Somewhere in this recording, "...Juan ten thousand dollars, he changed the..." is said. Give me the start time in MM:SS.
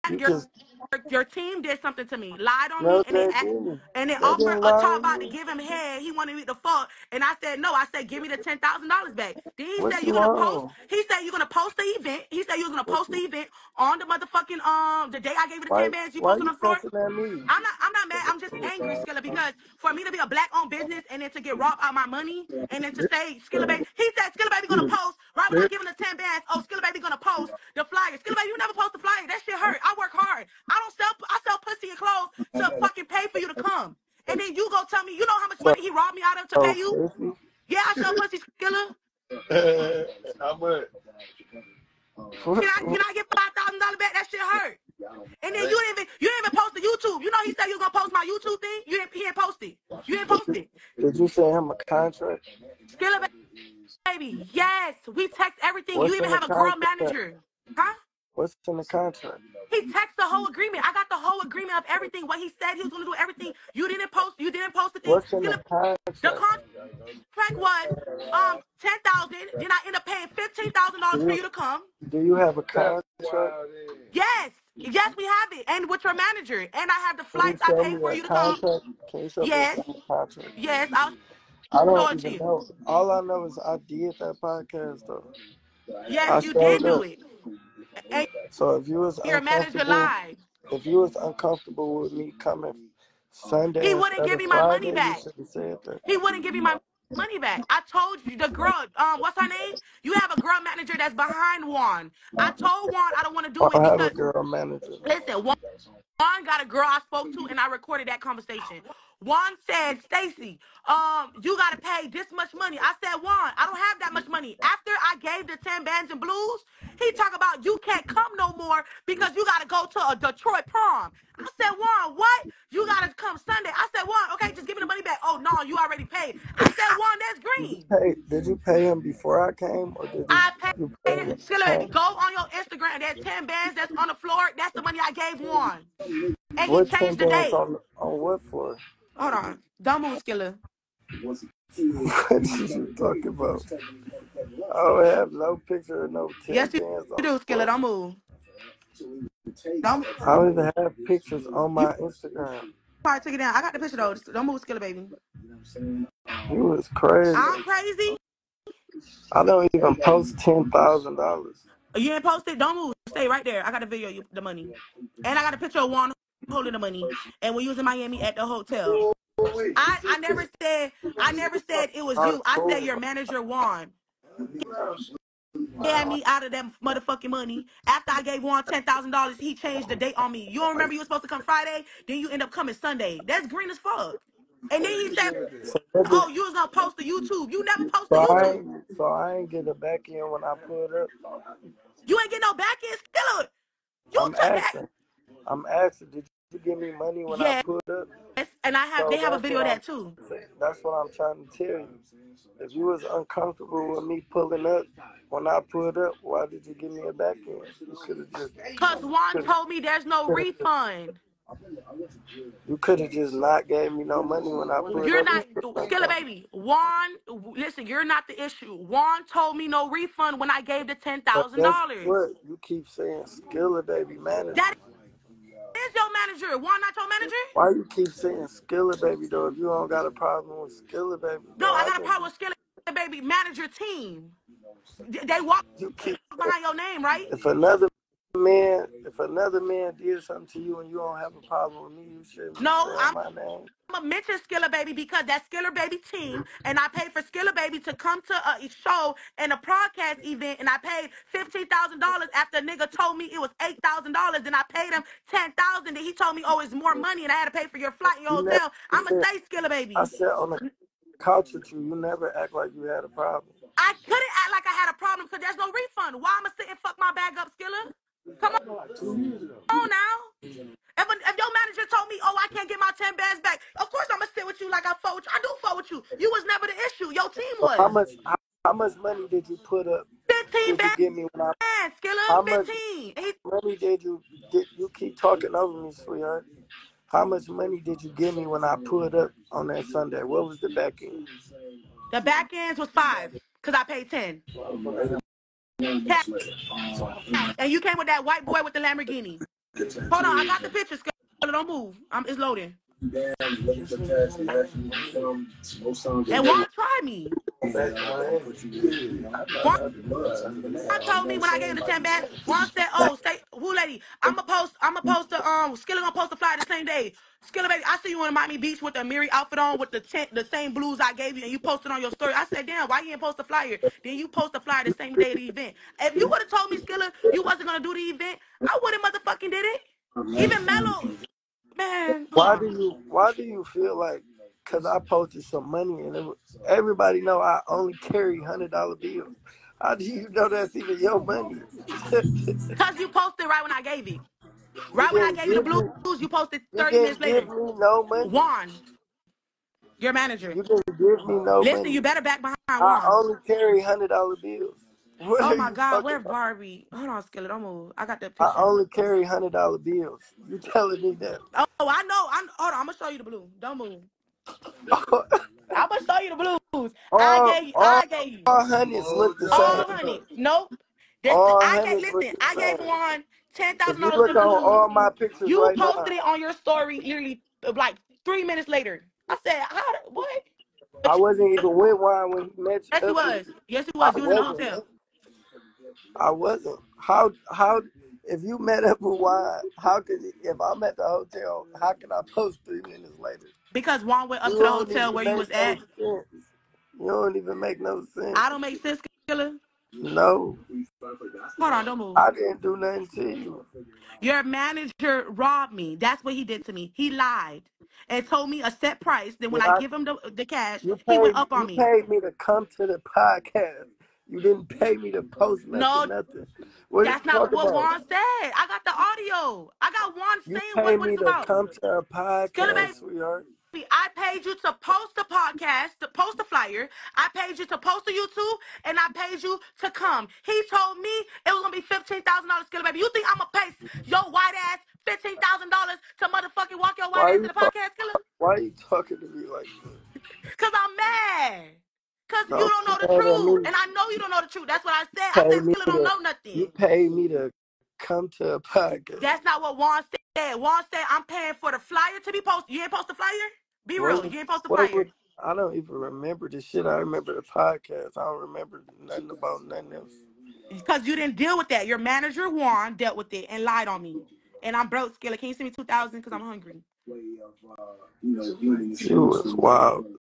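02:58.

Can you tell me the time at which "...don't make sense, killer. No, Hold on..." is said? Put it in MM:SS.
06:38.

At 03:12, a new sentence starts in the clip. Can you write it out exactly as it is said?
You ain't get no back end, still.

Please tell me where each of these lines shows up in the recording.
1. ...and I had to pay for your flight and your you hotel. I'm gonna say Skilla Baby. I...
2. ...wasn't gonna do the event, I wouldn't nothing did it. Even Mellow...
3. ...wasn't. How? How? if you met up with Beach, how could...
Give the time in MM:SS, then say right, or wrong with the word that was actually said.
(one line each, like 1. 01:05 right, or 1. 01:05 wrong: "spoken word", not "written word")
1. 04:17 right
2. 05:27 wrong: "motherfucking", not "nothing"
3. 06:26 wrong: "Juan", not "Beach".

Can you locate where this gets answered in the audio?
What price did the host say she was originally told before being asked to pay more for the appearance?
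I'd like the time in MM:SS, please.
04:13.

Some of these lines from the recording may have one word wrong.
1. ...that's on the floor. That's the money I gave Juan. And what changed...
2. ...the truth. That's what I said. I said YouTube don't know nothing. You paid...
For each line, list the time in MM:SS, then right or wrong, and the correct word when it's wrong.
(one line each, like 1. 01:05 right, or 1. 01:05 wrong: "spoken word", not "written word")
1. 02:13 right
2. 07:24 wrong: "Skilla", not "YouTube".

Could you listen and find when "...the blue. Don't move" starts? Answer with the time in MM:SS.
06:03.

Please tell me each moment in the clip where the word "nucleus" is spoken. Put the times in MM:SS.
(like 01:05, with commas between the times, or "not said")
not said.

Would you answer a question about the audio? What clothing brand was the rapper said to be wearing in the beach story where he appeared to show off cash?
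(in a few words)
Amiri.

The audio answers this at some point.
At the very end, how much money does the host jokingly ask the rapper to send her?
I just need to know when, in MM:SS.
07:45.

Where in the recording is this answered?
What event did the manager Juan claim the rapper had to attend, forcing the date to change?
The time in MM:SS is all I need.
02:00.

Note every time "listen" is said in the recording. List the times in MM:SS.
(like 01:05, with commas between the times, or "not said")
01:45, 03:37, 05:51, 06:12.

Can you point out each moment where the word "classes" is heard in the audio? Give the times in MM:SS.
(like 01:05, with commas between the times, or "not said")
not said.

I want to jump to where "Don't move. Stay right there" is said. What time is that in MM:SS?
02:42.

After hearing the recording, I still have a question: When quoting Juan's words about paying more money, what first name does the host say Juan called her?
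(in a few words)
Stacy.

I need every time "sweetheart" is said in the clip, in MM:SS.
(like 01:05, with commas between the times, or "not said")
04:45, 07:02.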